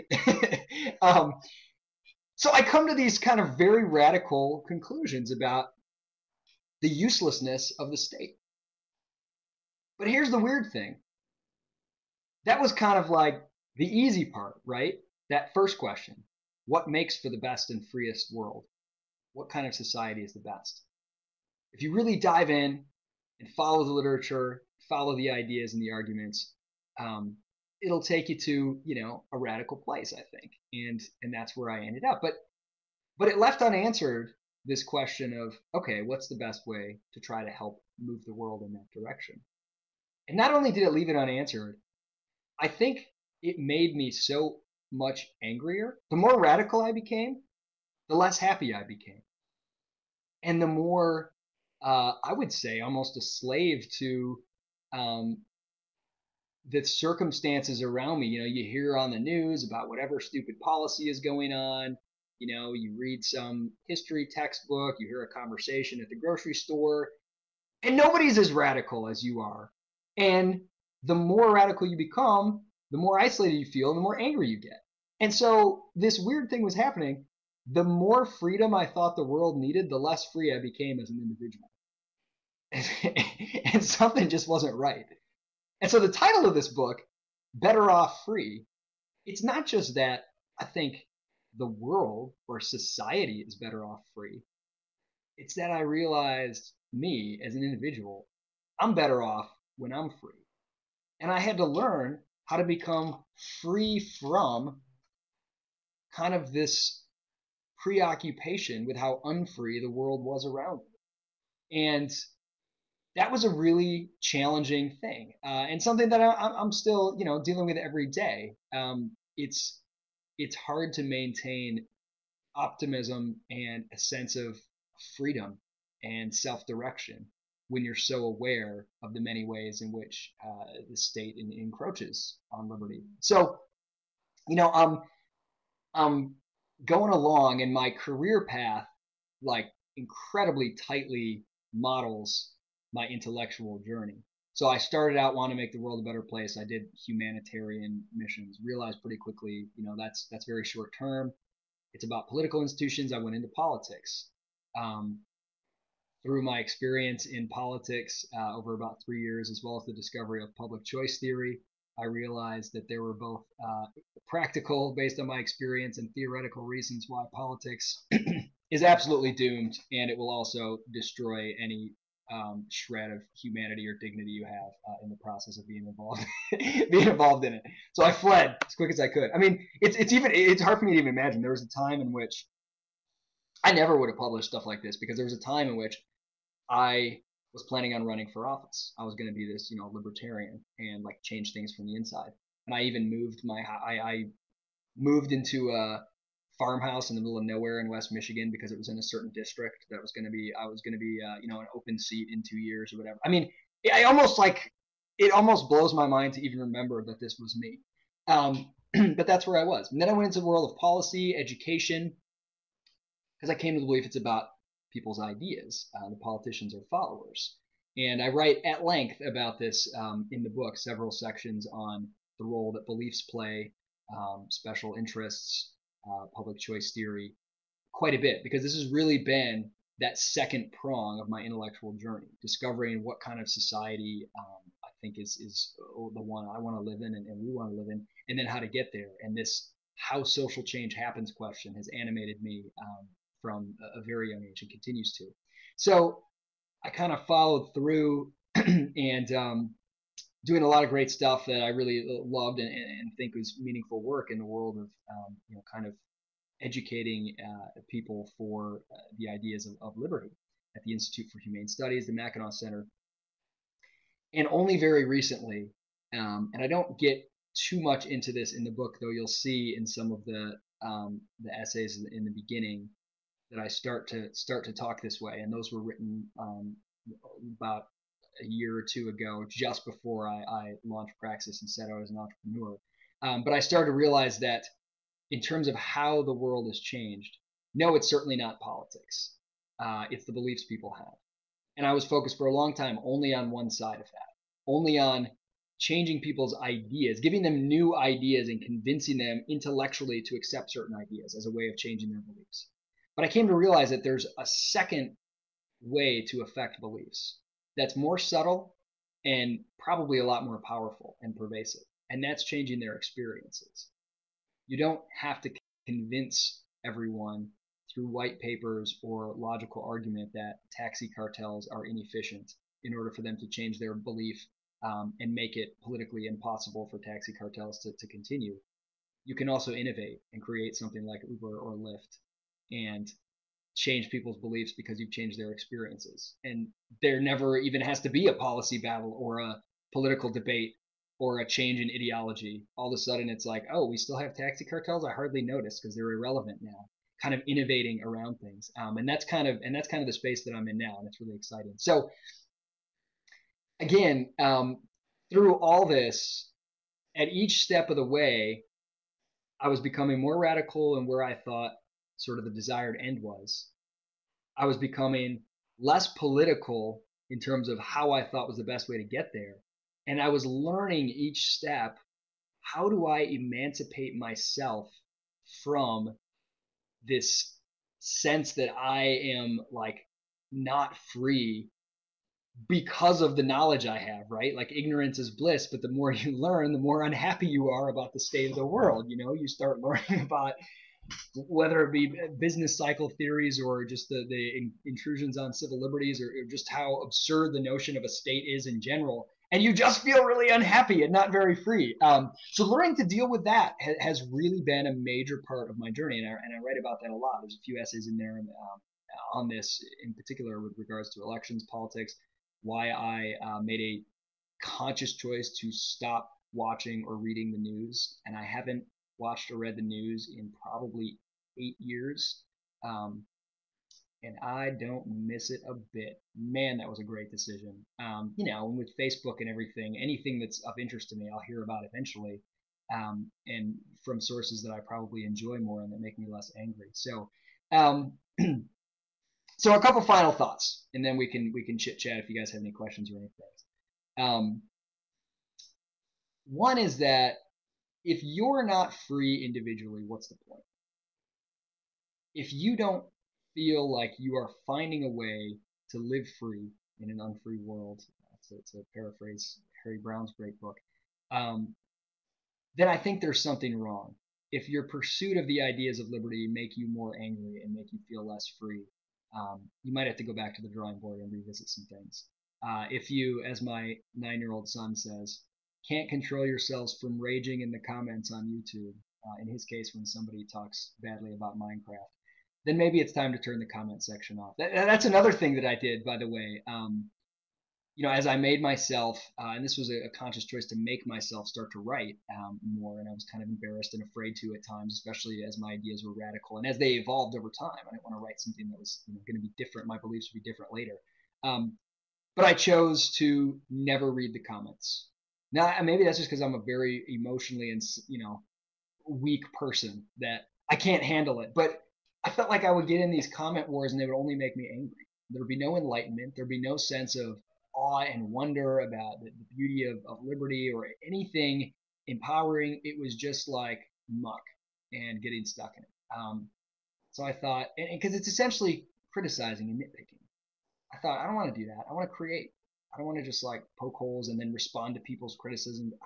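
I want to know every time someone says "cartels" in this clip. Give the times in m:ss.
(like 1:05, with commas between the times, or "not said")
5:21, 5:27, 5:44.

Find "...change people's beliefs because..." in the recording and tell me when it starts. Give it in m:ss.
5:33.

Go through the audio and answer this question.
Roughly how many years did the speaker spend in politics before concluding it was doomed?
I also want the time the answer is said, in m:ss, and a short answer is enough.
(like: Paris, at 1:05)
3 years, at 2:39.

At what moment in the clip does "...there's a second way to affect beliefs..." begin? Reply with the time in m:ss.
5:04.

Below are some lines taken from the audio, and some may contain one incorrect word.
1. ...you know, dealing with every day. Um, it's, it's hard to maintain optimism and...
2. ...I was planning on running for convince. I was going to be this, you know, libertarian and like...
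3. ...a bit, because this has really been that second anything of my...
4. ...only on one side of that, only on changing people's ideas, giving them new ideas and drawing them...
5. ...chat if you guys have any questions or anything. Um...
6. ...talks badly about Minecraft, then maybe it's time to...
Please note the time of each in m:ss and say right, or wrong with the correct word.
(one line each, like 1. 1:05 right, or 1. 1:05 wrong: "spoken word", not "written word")
1. 1:57 right
2. 3:06 wrong: "office", not "convince"
3. 3:48 wrong: "prong", not "anything"
4. 4:53 wrong: "convincing", not "drawing"
5. 7:21 right
6. 8:00 right.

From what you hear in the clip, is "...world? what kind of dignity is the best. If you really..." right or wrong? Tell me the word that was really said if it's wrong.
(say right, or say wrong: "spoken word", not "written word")
wrong: "society", not "dignity".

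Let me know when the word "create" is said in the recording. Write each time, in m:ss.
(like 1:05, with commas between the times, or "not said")
5:30, 8:52.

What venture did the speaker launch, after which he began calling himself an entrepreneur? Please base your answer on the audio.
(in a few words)
Praxis.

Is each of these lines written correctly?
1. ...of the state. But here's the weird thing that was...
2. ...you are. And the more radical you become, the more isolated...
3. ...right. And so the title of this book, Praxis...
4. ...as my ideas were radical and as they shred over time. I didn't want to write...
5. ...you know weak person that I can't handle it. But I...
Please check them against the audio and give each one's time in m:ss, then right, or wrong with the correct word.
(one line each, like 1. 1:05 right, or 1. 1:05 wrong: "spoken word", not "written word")
1. 0:07 right
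2. 1:09 right
3. 1:24 wrong: "Better", not "Praxis"
4. 8:15 wrong: "evolved", not "shred"
5. 8:28 right.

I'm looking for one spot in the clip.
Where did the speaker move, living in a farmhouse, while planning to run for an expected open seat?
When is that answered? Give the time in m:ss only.
3:17.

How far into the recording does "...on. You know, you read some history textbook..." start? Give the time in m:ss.
1:01.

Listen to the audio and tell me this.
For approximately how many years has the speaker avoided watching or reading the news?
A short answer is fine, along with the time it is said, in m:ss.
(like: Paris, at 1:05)
8 years, at 7:01.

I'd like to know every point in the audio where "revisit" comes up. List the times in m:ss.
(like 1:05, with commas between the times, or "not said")
7:51.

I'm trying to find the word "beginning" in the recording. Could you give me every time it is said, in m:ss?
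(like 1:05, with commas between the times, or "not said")
4:32.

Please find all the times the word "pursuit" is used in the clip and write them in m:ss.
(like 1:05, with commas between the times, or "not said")
7:44.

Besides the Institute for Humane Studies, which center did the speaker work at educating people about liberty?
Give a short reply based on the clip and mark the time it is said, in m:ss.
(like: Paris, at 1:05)
Mackinac Center, at 4:22.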